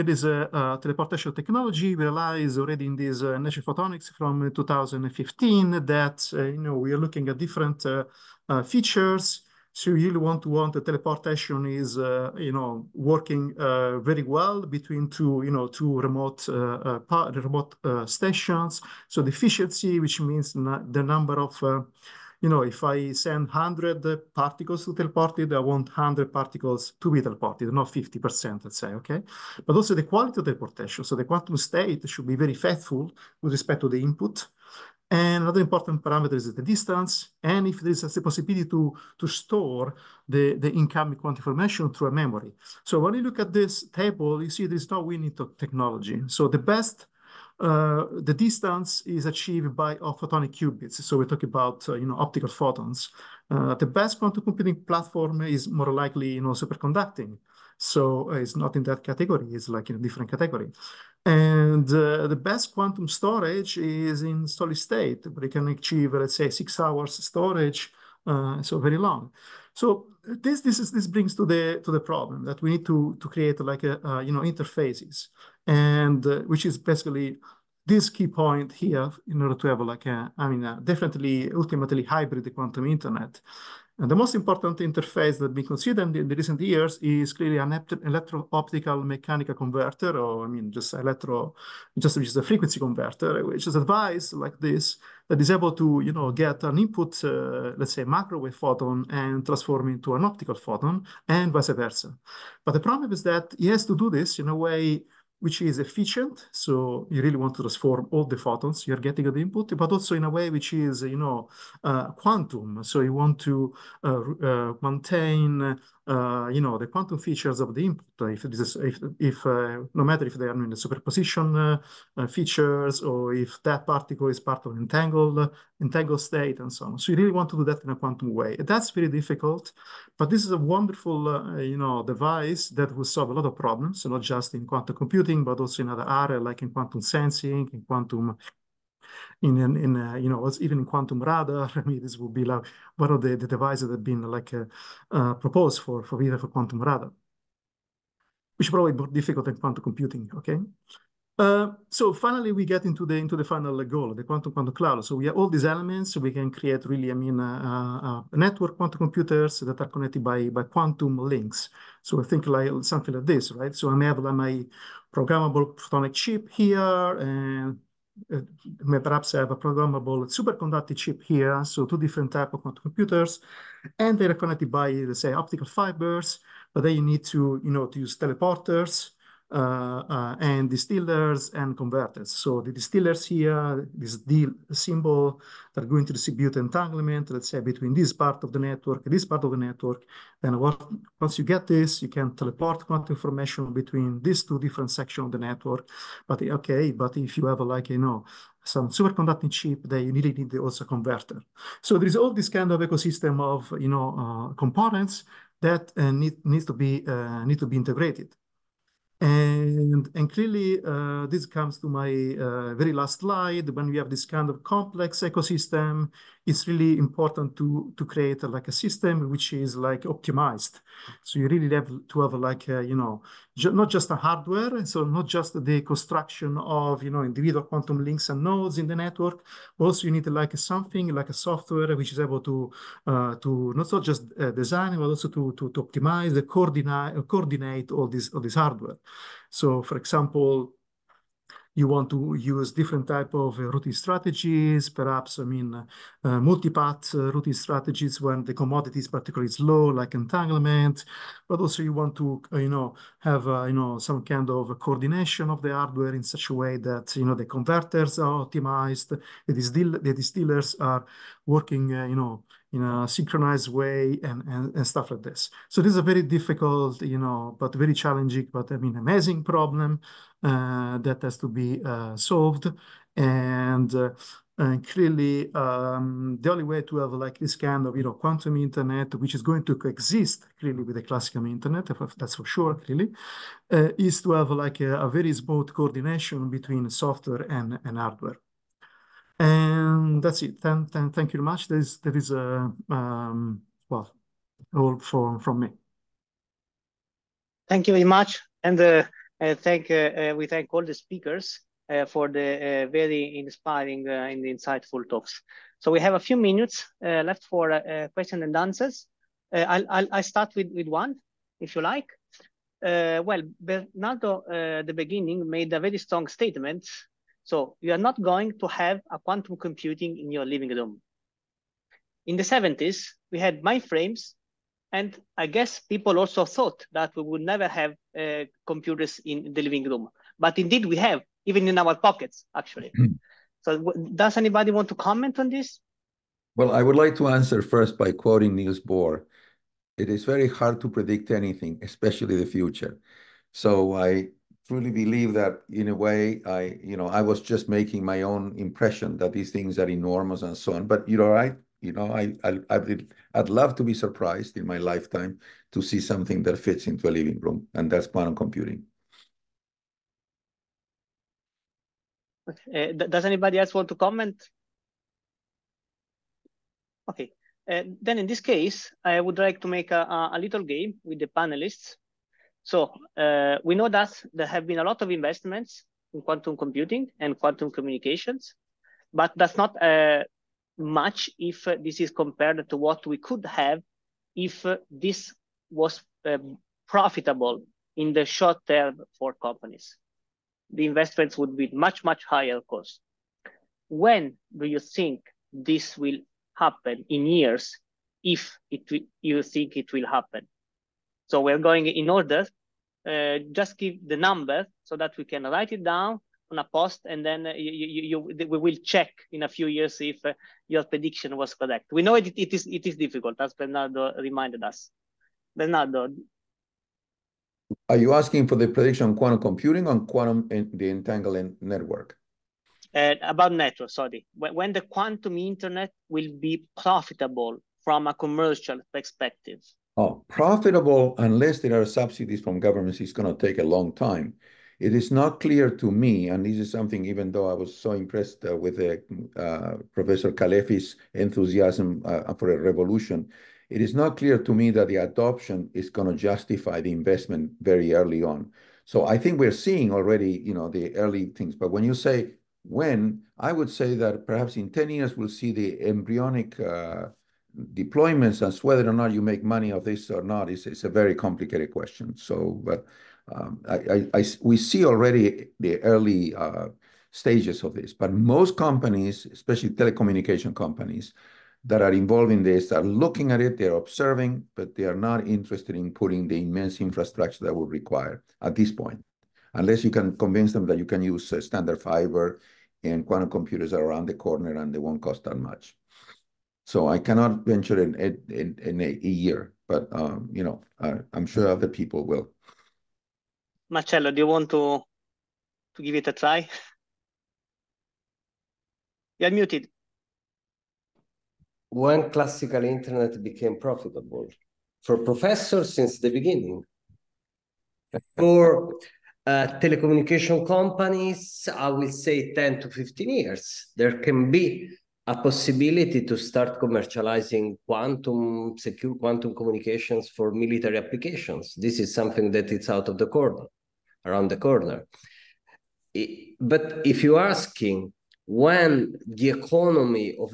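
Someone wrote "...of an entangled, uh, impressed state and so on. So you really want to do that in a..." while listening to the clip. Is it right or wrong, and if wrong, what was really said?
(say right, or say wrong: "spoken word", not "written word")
wrong: "entangled", not "impressed".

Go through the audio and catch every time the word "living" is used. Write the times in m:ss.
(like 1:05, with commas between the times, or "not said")
5:20, 5:29, 5:57.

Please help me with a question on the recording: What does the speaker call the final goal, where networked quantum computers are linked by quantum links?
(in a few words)
Quantum cloud.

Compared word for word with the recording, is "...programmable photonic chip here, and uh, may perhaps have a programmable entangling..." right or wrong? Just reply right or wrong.
wrong.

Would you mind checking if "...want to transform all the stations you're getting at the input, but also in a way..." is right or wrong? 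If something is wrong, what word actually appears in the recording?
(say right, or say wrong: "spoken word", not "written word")
wrong: "photons", not "stations".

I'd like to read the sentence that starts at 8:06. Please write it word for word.
So I cannot venture in a year, but um, you know, uh, I'm sure other people will.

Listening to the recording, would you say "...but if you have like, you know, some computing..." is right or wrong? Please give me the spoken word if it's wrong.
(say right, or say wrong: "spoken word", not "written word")
wrong: "superconducting", not "computing".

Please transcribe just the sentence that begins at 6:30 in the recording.
The investments would be much, much higher cost.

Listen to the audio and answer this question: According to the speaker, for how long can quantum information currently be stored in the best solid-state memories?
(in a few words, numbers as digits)
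6 hours.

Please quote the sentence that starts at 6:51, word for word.
We know it, it is it is difficult, as Bernardo reminded us.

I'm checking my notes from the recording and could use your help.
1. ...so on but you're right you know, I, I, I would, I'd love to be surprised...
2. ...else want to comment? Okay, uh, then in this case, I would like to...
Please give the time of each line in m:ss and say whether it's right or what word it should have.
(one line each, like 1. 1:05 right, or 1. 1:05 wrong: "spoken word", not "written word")
1. 5:50 right
2. 6:03 right.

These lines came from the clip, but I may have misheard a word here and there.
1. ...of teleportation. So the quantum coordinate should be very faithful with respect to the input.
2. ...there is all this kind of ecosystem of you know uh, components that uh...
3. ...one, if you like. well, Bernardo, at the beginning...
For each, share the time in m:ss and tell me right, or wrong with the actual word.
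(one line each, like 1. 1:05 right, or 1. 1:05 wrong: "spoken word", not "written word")
1. 0:30 wrong: "state", not "coordinate"
2. 3:21 right
3. 5:10 right.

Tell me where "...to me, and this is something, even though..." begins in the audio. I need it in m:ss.
7:15.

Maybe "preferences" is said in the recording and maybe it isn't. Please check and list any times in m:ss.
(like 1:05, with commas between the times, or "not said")
not said.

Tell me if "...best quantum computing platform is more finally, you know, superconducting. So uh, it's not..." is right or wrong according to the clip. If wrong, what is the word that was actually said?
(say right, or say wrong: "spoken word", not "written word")
wrong: "likely", not "finally".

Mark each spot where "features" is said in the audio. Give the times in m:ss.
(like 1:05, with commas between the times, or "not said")
0:08, 1:57, 2:02.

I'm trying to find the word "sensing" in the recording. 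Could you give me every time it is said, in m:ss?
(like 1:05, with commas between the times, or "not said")
2:17.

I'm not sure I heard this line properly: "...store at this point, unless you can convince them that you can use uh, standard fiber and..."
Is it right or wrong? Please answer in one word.
wrong.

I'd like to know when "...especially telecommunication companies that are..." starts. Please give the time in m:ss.
7:49.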